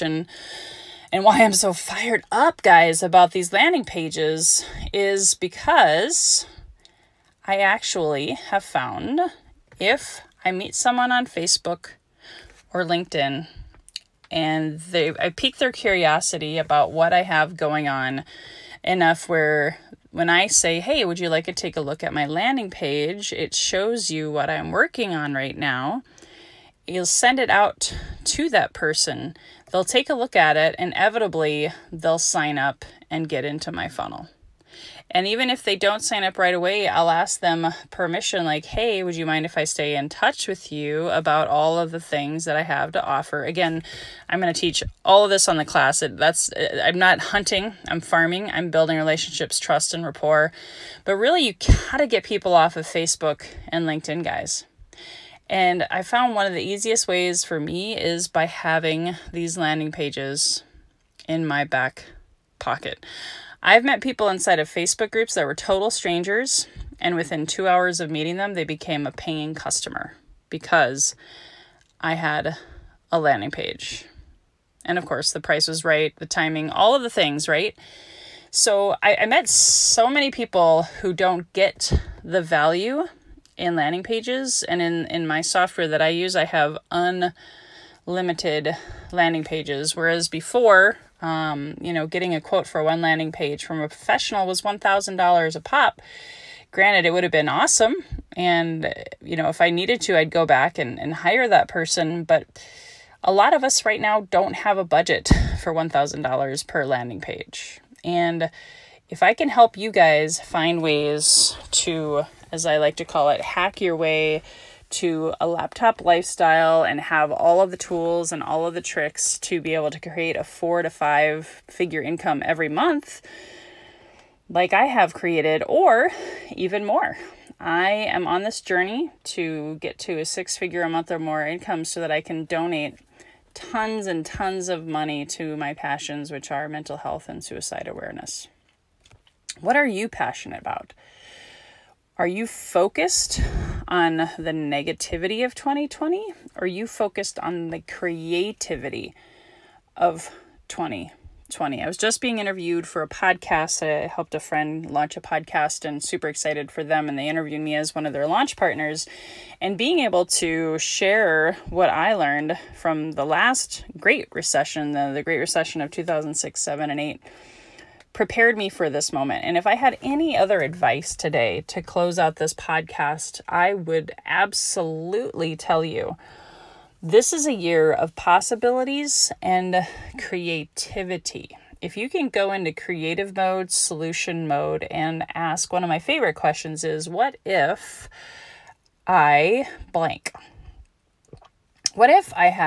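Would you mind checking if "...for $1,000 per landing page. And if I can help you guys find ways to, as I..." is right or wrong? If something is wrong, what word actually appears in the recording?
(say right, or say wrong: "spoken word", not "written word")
right.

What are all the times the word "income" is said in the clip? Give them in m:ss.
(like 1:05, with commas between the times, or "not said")
2:02, 2:11.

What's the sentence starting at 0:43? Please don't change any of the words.
Again, I'm going to teach all of this on the class.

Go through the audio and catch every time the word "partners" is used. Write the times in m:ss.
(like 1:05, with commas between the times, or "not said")
2:38.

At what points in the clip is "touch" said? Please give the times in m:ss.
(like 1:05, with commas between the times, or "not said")
0:40.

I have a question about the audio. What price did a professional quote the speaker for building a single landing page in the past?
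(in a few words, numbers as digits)
$1,000.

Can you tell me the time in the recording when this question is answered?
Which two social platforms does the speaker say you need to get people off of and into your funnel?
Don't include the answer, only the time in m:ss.
0:52.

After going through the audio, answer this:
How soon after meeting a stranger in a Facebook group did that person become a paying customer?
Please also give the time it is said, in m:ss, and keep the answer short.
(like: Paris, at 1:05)
two hours, at 1:07.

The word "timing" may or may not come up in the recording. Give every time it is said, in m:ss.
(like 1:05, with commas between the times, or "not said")
1:16.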